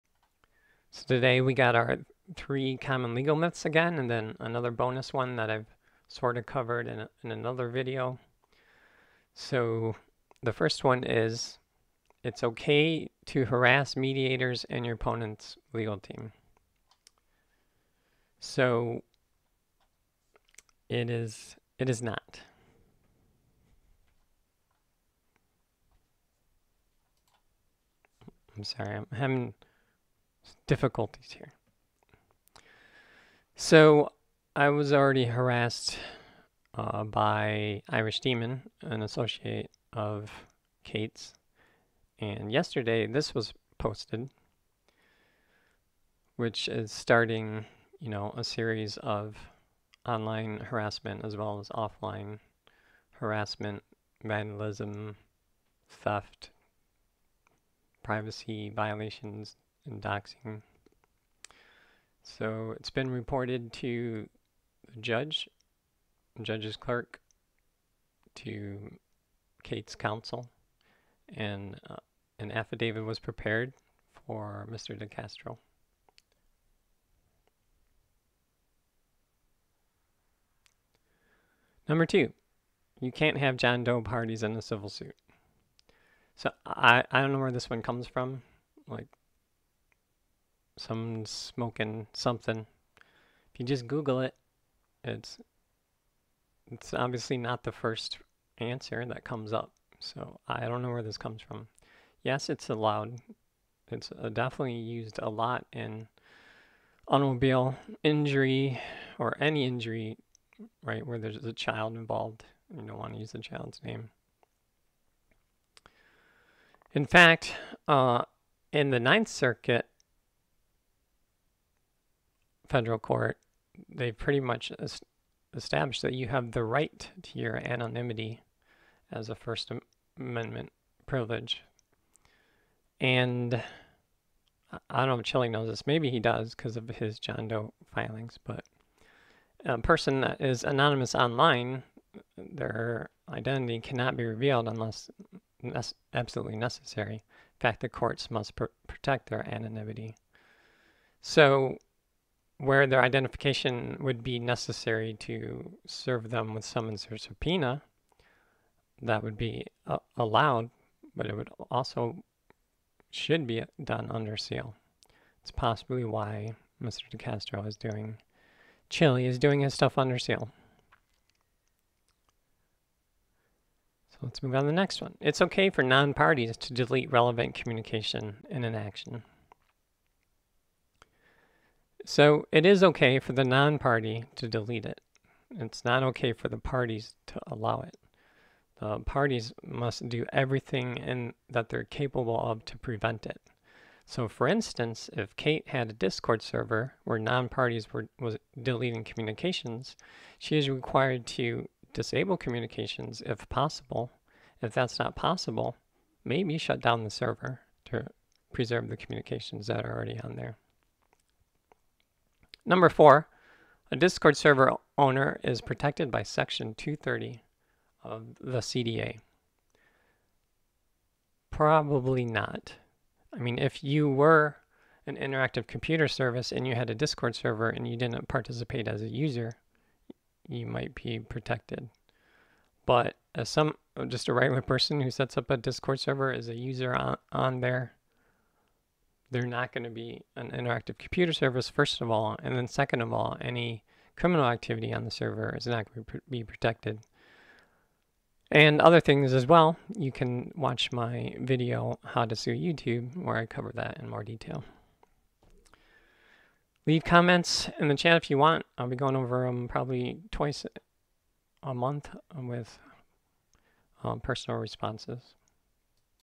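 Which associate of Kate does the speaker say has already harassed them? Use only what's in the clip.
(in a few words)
Irish Demon.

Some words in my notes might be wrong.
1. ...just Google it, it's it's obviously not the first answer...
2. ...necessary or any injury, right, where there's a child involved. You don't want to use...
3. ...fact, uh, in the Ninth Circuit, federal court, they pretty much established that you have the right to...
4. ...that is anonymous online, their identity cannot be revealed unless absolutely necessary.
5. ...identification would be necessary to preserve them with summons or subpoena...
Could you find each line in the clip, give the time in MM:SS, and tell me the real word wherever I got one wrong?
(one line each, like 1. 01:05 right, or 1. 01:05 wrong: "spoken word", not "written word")
1. 01:33 right
2. 01:48 wrong: "injury", not "necessary"
3. 01:57 right
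4. 02:20 right
5. 02:33 wrong: "serve", not "preserve".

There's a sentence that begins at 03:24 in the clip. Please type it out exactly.
If that's not possible, maybe shut down the server to preserve the communications that are already on there.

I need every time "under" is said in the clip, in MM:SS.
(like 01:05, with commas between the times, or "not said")
02:44, 02:49.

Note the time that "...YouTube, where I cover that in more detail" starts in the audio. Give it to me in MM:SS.
04:12.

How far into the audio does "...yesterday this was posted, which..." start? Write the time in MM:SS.
00:42.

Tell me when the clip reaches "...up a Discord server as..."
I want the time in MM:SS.
03:55.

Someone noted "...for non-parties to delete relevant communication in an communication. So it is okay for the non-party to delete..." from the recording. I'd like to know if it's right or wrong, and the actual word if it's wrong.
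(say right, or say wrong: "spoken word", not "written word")
wrong: "action", not "communication".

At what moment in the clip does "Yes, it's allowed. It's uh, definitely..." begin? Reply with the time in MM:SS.
01:42.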